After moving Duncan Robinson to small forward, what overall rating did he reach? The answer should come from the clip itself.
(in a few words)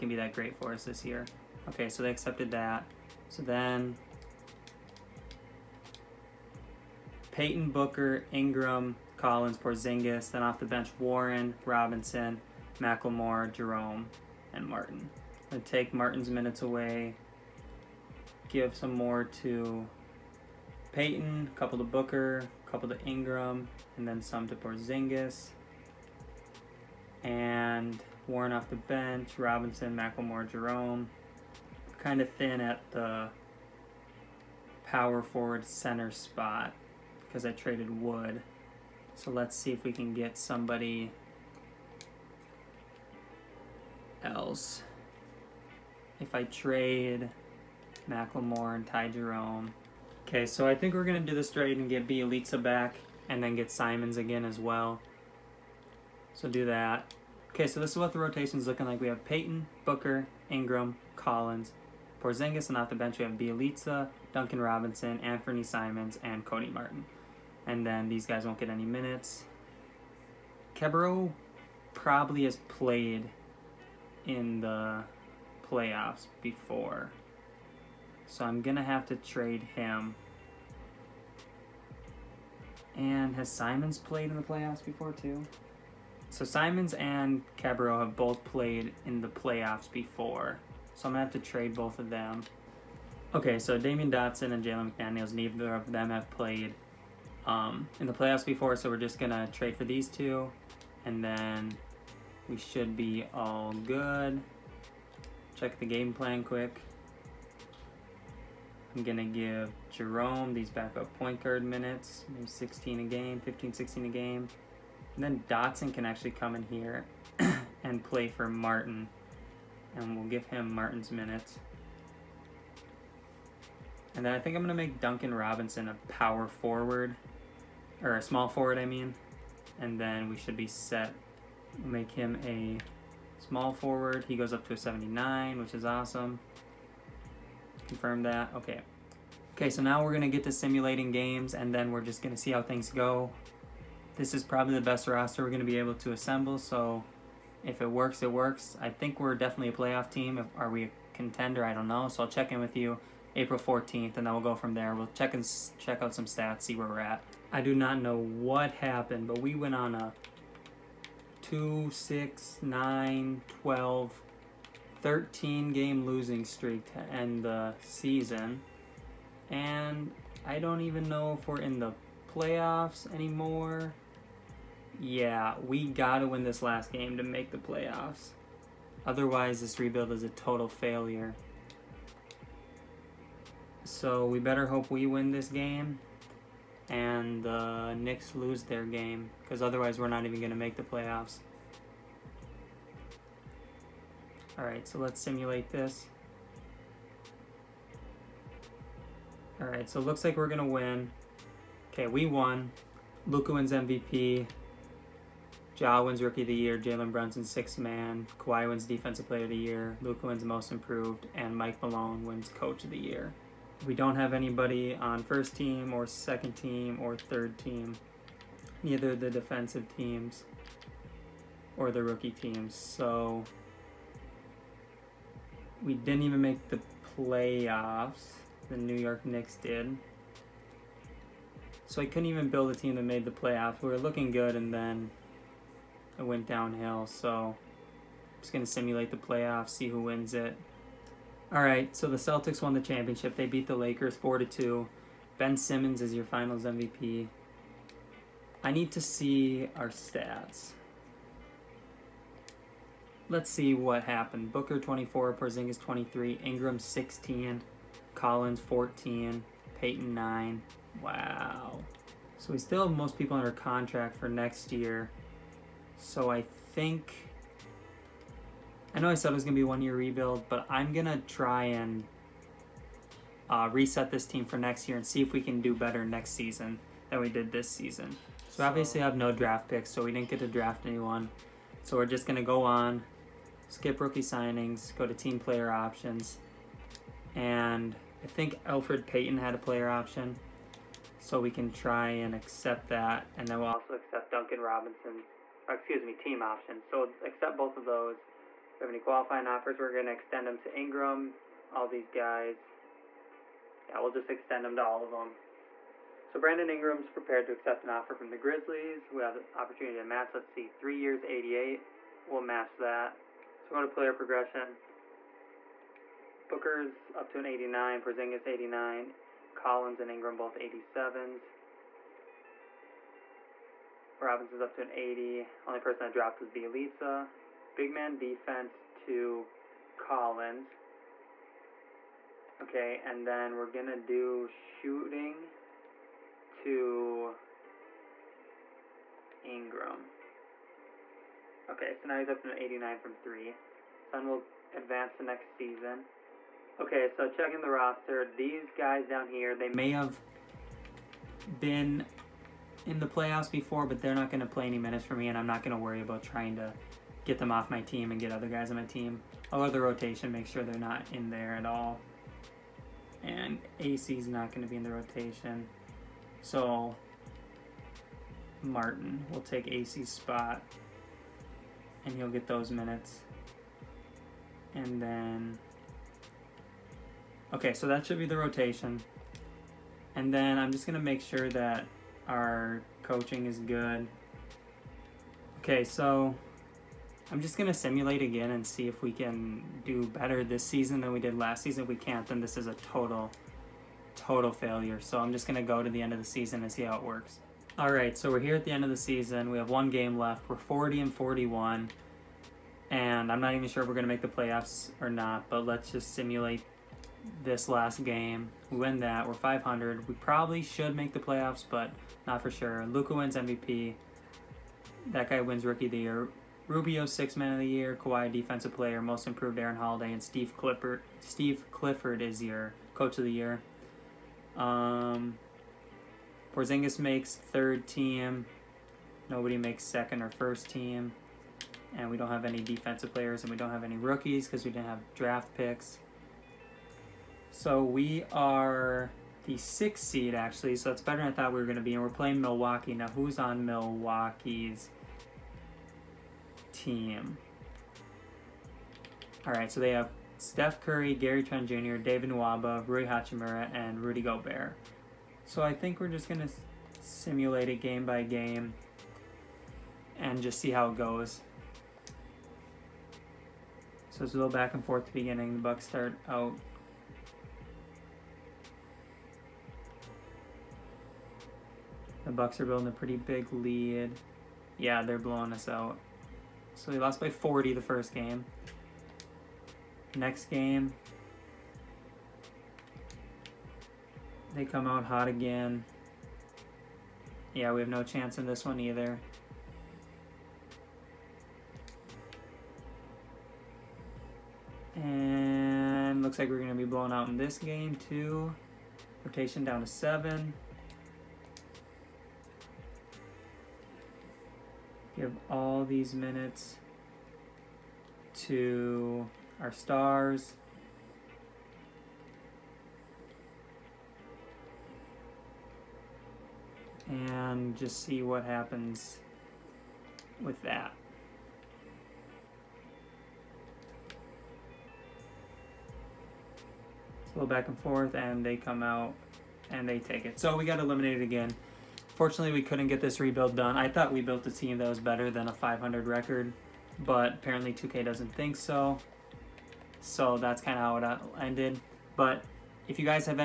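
79.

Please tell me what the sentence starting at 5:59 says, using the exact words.
I'll let the rotation make sure they're not in there at all.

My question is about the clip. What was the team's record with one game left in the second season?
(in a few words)
40-41.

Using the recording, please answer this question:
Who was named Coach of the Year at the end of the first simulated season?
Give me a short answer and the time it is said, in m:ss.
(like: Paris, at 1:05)
Mike Malone, at 3:31.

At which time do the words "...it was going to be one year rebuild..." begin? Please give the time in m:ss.
4:29.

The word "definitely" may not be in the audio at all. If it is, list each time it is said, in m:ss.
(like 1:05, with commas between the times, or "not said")
2:29.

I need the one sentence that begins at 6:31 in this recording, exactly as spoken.
If we can't, then this is a total, total failure.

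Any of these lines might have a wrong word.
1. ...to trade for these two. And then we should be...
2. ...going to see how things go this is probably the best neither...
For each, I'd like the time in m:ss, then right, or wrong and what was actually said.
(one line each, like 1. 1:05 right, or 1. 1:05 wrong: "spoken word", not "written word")
1. 1:39 right
2. 2:22 wrong: "roster", not "neither".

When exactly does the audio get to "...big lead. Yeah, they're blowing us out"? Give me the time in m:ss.
7:53.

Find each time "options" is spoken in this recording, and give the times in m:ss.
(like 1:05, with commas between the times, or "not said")
4:45, 4:49, 4:56.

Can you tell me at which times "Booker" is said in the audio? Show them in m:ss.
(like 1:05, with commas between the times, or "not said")
0:07, 0:21, 0:59, 4:14, 5:16.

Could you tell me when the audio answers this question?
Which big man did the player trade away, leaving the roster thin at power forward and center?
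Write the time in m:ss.
0:38.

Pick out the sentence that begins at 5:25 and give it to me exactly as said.
Only person I dropped would be Bjelica.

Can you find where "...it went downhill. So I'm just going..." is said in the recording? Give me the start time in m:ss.
3:56.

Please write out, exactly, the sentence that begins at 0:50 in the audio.
Okay, so I think we're going to do this trade and get Bjelica back and then get Simons again as well.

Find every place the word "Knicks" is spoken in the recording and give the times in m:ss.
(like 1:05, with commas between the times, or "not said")
3:07, 3:49.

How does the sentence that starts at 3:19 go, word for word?
Alright, so looks like we're going to win.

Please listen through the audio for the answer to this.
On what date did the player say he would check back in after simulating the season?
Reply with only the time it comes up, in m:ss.
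2:33.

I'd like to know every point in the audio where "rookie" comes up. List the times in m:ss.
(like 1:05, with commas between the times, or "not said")
3:26, 3:42, 4:43, 6:55, 7:13.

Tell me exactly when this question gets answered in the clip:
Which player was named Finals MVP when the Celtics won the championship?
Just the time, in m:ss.
4:05.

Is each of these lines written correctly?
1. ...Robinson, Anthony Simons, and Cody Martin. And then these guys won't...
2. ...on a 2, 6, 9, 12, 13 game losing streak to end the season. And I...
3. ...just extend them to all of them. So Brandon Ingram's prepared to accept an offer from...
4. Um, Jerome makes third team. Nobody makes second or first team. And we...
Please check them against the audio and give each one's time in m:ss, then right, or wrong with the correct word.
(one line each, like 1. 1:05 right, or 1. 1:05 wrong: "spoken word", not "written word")
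1. 1:04 right
2. 2:39 right
3. 5:04 right
4. 7:04 wrong: "Porzingis", not "Jerome".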